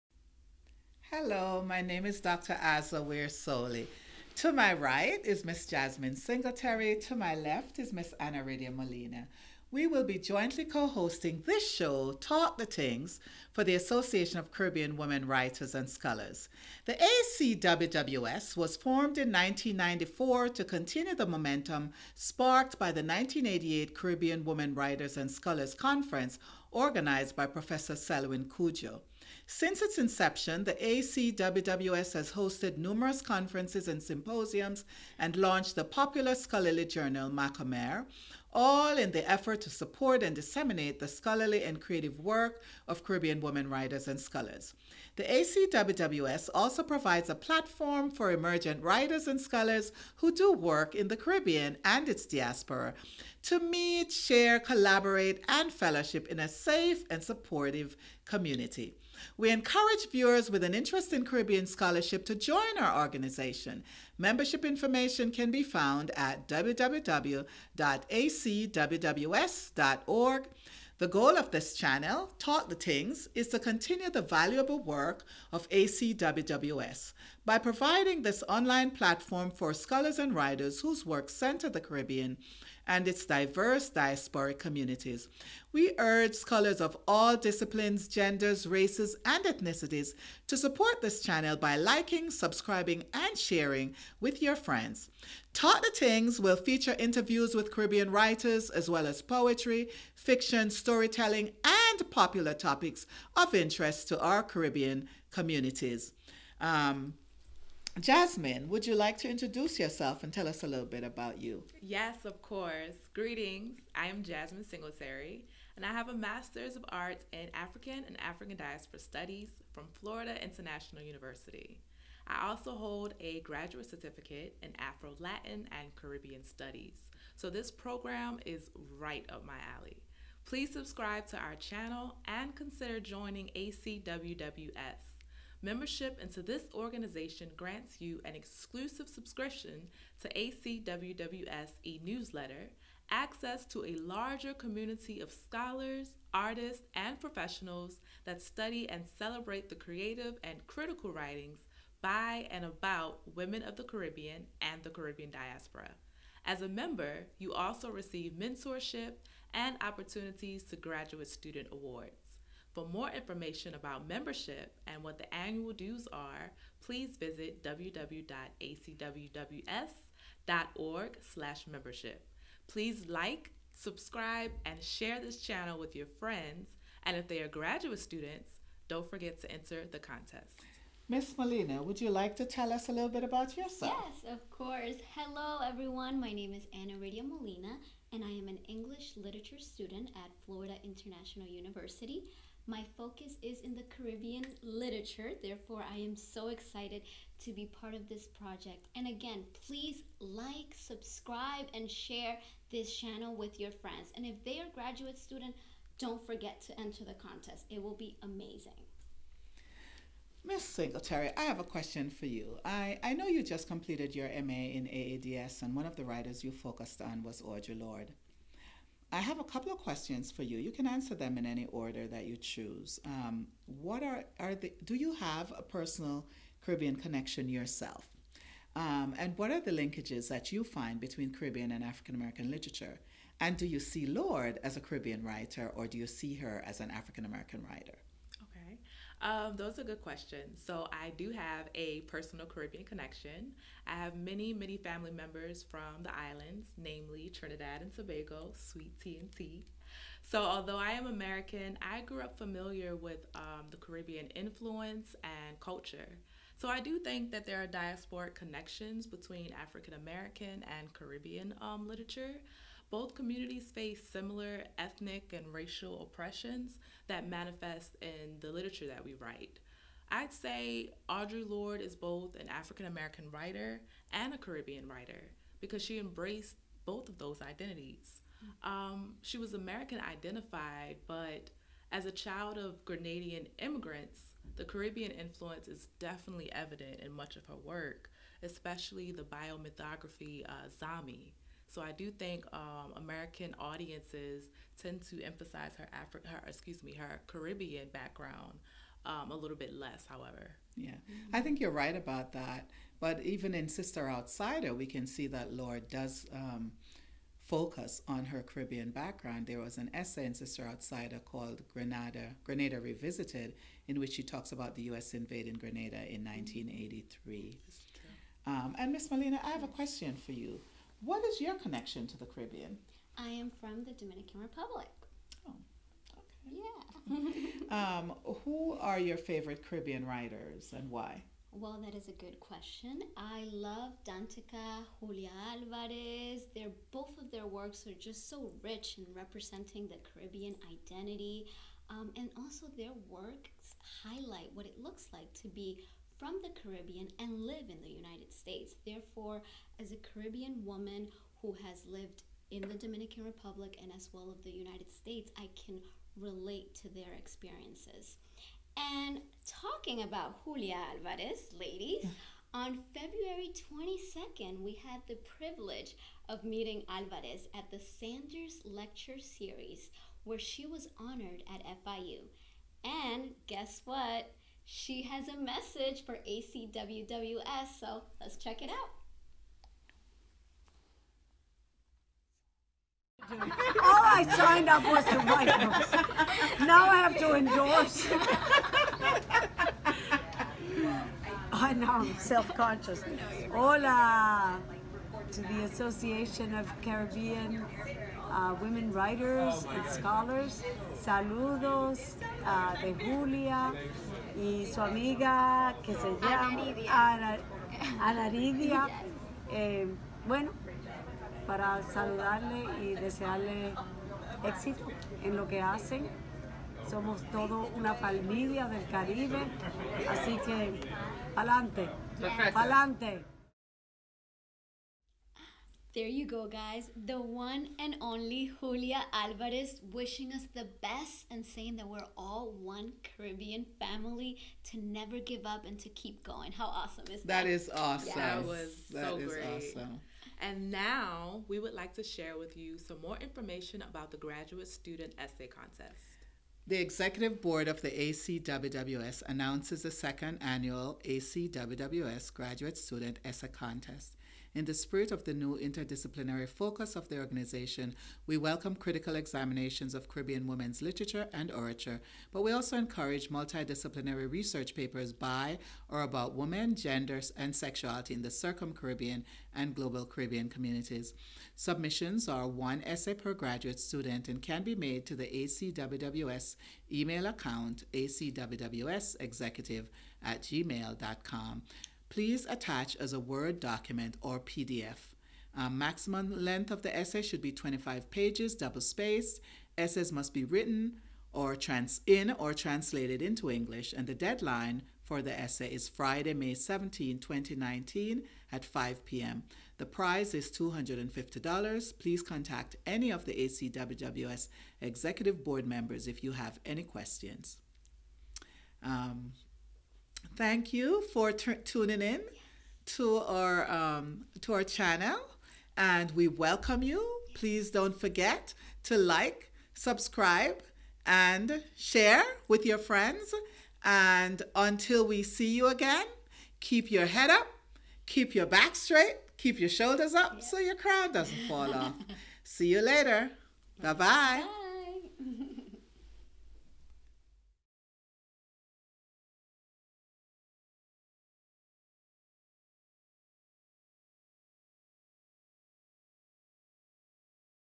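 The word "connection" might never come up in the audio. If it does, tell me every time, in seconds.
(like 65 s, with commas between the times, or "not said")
226 s, 242 s, 258 s, 321 s.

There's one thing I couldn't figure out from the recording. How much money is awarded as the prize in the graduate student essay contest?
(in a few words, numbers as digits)
$250.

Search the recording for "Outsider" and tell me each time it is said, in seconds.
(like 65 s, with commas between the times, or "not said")
304 s, 310 s.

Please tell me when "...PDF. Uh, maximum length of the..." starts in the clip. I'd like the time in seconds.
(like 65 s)
484 s.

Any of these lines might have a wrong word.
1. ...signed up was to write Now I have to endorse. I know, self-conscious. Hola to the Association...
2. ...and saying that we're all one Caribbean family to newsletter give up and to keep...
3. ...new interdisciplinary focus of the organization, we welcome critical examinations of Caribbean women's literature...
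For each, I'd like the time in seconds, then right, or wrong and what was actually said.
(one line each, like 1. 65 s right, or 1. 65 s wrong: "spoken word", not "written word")
1. 384 s right
2. 431 s wrong: "never", not "newsletter"
3. 455 s right.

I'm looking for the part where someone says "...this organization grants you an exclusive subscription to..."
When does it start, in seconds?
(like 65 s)
136 s.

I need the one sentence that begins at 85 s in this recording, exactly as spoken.
We urge scholars of all disciplines, genders, races, and ethnicities to support this channel by liking, subscribing, and sharing with your friends.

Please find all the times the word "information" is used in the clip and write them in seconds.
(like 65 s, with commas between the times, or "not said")
64 s, 163 s, 443 s.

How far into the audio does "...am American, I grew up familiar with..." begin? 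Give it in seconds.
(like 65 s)
250 s.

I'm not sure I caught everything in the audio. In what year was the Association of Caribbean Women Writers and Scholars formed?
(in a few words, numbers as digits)
1994.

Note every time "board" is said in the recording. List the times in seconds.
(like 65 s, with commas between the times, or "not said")
447 s, 505 s.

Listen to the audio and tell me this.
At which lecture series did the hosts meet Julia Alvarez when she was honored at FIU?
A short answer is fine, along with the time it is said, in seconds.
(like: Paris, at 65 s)
Sanders Lecture Series, at 367 s.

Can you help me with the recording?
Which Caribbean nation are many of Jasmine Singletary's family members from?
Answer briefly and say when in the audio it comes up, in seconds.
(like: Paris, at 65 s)
Trinidad and Tobago, at 247 s.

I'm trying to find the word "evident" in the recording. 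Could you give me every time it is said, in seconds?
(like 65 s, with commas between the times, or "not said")
286 s.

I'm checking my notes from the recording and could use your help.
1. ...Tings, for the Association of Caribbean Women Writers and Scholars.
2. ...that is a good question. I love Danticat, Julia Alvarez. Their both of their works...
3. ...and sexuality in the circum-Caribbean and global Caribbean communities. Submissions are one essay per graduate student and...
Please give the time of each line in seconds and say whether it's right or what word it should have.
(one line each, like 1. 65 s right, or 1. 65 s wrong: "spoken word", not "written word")
1. 12 s right
2. 331 s right
3. 467 s right.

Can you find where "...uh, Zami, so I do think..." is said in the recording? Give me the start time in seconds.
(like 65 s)
290 s.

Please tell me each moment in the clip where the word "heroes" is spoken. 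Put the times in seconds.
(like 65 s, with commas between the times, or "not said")
not said.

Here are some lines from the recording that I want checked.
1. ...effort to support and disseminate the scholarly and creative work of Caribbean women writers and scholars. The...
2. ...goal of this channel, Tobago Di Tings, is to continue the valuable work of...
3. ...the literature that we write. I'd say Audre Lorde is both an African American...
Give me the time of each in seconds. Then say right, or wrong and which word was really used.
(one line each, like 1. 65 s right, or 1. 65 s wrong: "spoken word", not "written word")
1. 39 s right
2. 71 s wrong: "Talk", not "Tobago"
3. 268 s right.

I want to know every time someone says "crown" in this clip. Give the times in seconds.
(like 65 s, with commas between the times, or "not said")
530 s.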